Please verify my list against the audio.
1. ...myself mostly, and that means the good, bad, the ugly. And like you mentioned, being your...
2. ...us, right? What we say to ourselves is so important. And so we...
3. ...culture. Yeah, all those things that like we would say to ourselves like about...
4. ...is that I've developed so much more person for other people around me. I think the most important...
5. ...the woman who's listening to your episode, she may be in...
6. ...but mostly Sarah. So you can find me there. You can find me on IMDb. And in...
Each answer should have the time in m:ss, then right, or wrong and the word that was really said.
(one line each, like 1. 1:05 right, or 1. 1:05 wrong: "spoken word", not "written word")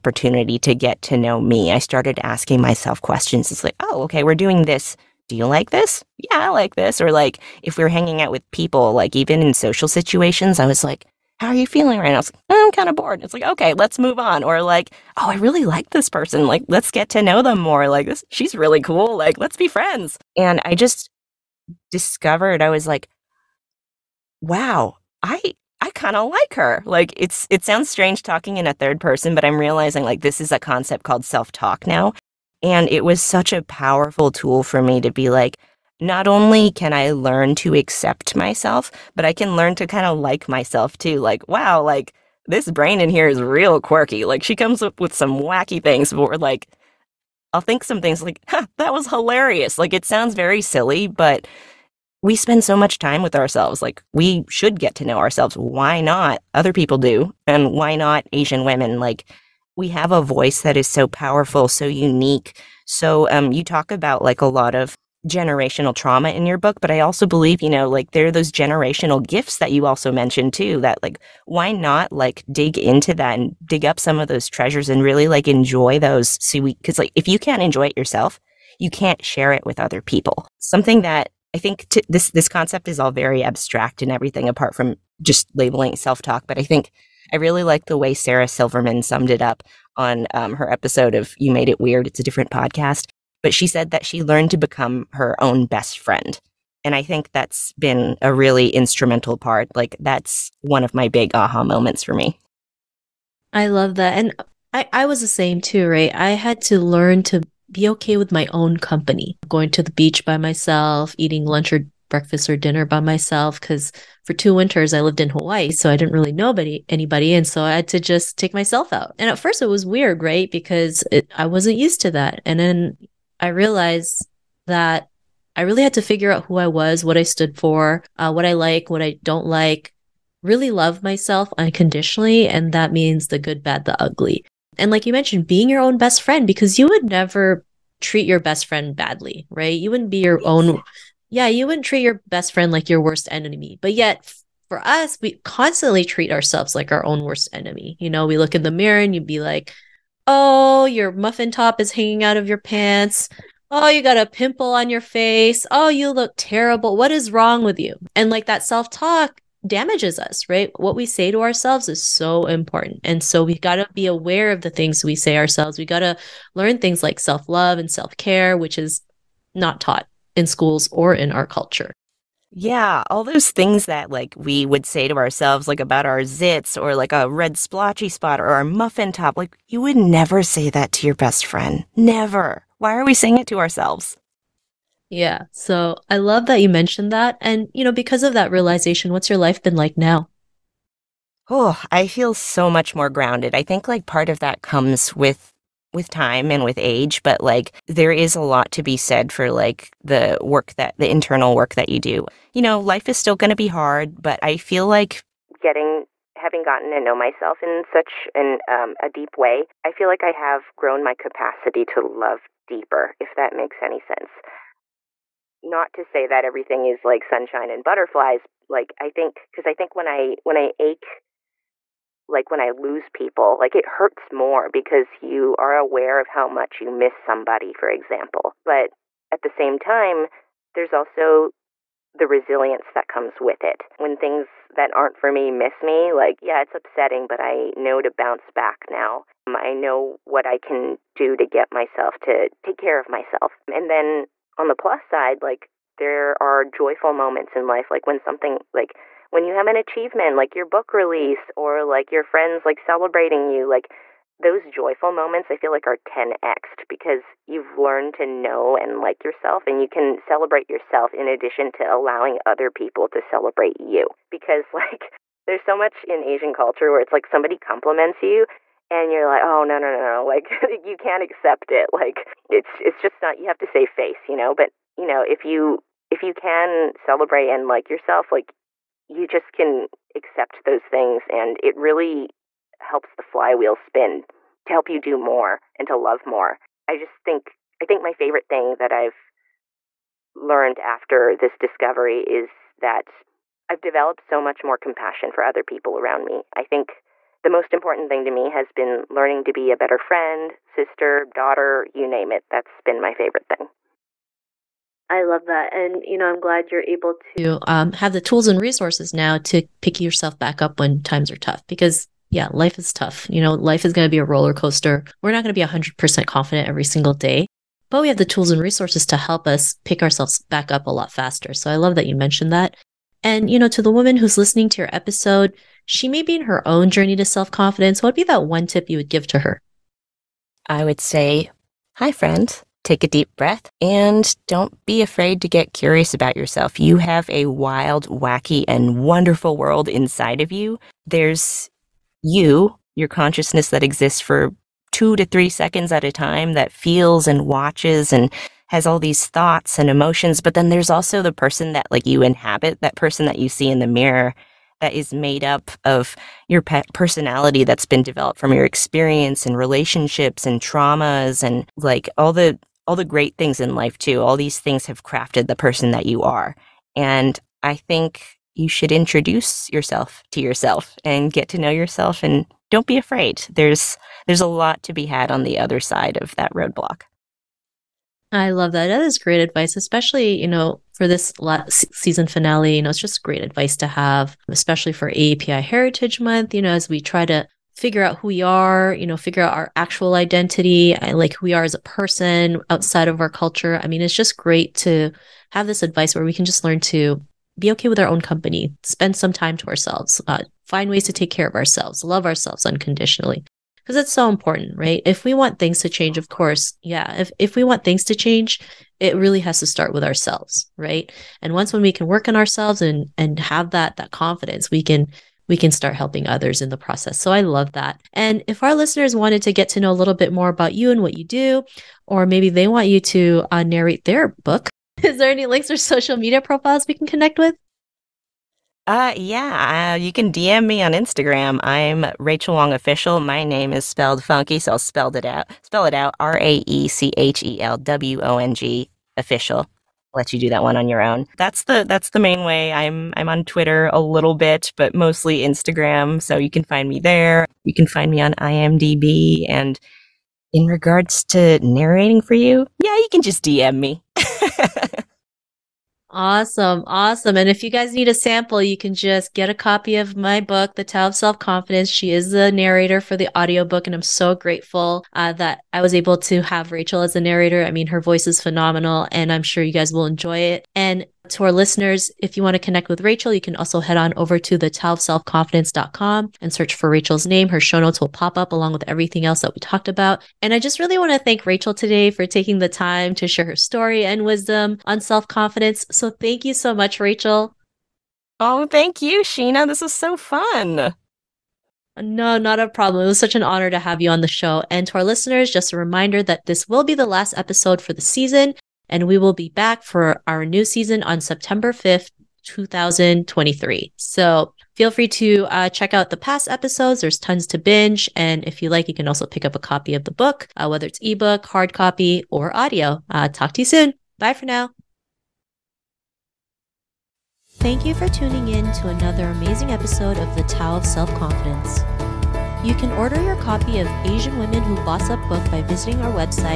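1. 2:11 wrong: "unconditionally", not "mostly"
2. 2:40 right
3. 2:51 right
4. 4:52 wrong: "compassion", not "person"
5. 5:23 right
6. 7:24 wrong: "Instagram", not "Sarah".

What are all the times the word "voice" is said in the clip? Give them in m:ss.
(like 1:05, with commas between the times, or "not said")
1:00, 7:48.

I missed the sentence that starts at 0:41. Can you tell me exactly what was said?
Like, wow, like this brain in here is real quirky.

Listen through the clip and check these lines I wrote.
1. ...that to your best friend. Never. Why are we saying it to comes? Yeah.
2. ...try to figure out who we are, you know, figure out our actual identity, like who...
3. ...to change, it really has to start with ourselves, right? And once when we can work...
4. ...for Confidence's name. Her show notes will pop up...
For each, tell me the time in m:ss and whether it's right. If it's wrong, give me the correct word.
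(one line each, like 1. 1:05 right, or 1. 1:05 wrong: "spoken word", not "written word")
1. 3:00 wrong: "ourselves", not "comes"
2. 6:26 right
3. 6:48 right
4. 7:56 wrong: "Raechel", not "Confidence".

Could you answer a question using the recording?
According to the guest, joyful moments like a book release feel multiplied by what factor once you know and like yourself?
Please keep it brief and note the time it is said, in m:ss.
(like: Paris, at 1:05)
10x, at 4:15.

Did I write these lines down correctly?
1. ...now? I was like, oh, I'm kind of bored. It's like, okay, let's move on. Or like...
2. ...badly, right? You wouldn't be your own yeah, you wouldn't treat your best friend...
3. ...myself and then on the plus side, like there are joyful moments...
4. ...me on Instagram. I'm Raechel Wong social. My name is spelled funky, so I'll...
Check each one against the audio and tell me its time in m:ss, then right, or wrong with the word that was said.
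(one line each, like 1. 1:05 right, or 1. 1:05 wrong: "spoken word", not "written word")
1. 0:12 right
2. 2:18 right
3. 4:03 right
4. 7:10 wrong: "official", not "social".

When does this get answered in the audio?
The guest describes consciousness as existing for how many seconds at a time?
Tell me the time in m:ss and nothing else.
5:44.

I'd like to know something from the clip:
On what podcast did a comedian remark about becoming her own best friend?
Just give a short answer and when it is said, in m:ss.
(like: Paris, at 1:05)
You Made It Weird, at 1:31.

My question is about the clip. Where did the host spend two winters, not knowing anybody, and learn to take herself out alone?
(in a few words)
Hawaii.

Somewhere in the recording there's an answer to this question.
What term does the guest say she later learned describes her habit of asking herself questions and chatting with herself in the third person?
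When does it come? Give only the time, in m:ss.
0:31.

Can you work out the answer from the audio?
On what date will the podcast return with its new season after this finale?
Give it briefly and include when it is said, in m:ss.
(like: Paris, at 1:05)
September 5th, 2023, at 8:21.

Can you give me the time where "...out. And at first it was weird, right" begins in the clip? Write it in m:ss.
1:58.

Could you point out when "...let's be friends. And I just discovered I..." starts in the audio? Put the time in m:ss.
0:19.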